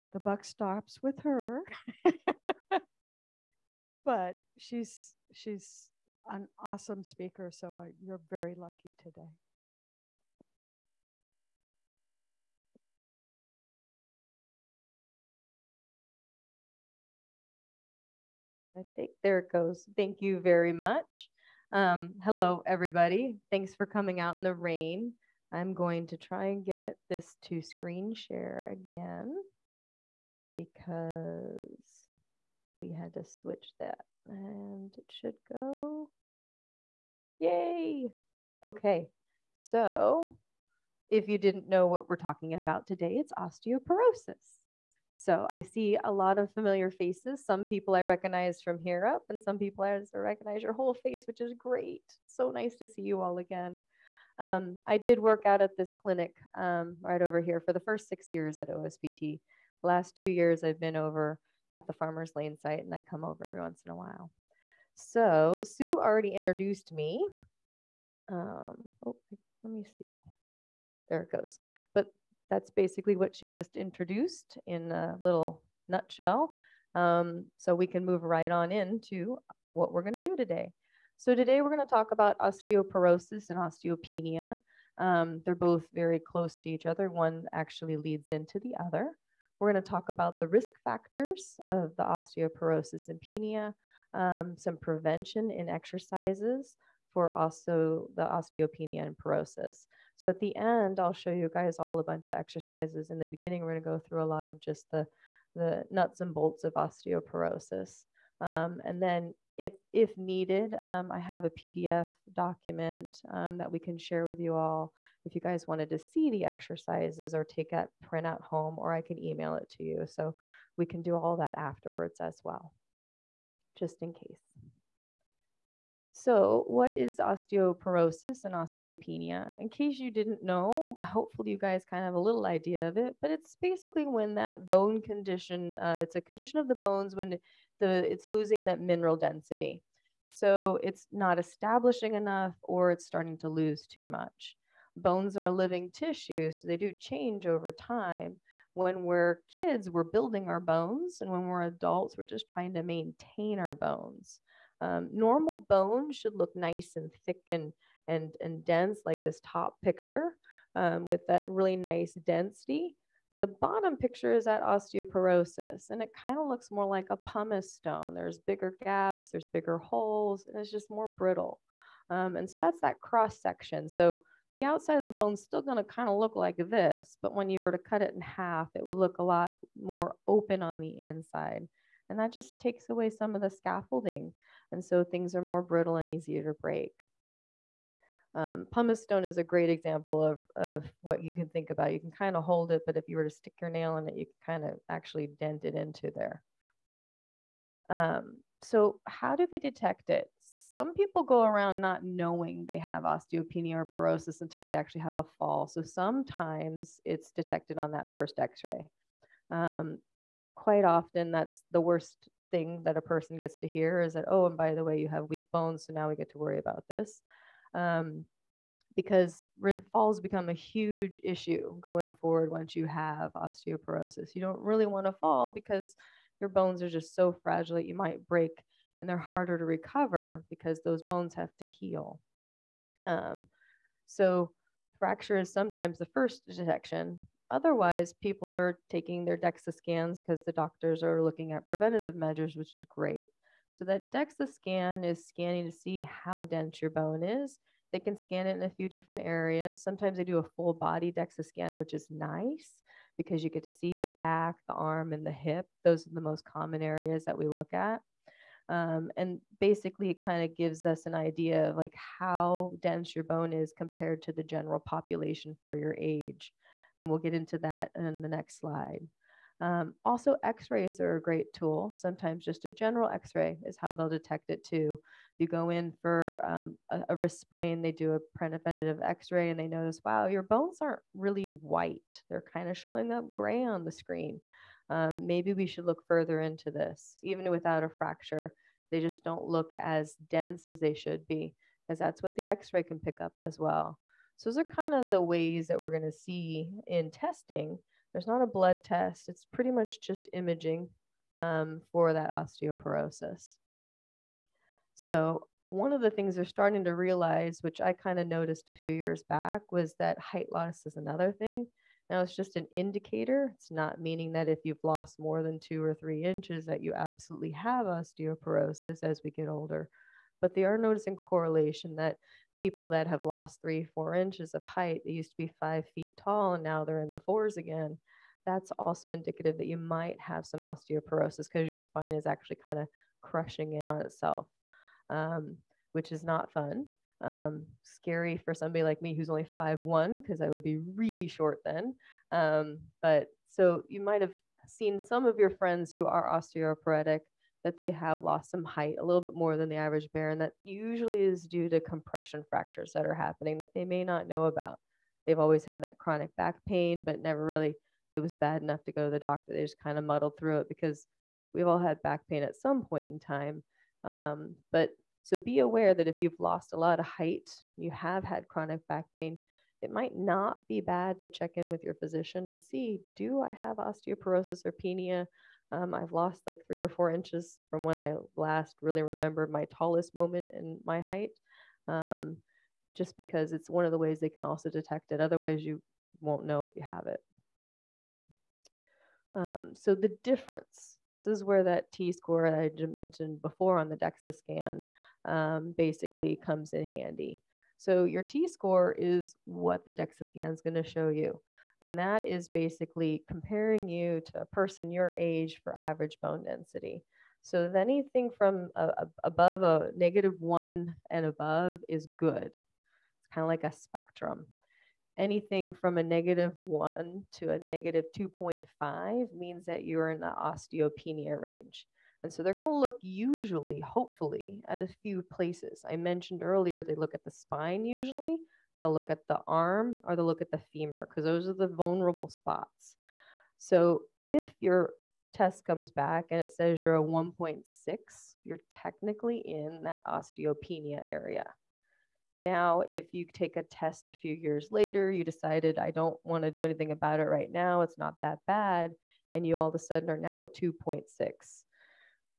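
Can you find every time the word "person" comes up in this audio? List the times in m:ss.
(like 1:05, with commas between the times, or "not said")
3:33, 6:44.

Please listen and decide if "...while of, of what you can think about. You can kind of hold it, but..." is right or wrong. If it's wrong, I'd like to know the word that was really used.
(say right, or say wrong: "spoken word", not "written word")
wrong: "example", not "while".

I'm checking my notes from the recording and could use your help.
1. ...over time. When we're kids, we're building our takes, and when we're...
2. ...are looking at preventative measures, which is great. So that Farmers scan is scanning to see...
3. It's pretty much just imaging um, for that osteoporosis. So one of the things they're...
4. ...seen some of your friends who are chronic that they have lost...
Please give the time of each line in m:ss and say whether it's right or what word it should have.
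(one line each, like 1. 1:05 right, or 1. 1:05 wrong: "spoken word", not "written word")
1. 2:27 wrong: "bones", not "takes"
2. 4:01 wrong: "DEXA", not "Farmers"
3. 4:59 right
4. 5:44 wrong: "osteoporotic", not "chronic".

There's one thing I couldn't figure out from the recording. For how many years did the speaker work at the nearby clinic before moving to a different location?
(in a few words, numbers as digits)
6.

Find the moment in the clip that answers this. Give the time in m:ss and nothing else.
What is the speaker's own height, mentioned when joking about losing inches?
5:39.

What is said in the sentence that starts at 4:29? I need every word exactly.
Um, also, x-rays are a great tool.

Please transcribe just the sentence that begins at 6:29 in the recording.
Um, so the difference, this is where that t-score I mentioned before on the DEXA scan um, basically comes in handy.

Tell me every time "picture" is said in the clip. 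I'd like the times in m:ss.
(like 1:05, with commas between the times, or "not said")
2:39, 2:43.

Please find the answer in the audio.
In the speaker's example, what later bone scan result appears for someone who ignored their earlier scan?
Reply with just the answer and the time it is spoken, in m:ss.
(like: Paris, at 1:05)
2.6, at 7:30.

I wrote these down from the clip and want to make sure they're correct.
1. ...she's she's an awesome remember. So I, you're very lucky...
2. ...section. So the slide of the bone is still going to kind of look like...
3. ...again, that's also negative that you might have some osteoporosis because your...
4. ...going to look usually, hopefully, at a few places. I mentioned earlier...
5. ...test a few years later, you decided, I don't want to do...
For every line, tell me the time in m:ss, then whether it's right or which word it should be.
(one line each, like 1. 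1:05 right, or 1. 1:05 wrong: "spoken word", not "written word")
1. 0:04 wrong: "speaker", not "remember"
2. 2:53 wrong: "outside", not "slide"
3. 5:27 wrong: "indicative", not "negative"
4. 7:02 right
5. 7:23 right.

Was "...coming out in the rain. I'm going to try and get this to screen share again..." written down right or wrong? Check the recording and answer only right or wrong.
right.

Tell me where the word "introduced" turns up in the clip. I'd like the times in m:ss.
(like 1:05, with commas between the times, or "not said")
1:06, 1:13.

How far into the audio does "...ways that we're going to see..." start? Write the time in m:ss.
4:55.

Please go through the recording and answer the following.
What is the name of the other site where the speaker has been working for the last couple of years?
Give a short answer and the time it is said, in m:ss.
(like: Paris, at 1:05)
Farmers Lane, at 1:01.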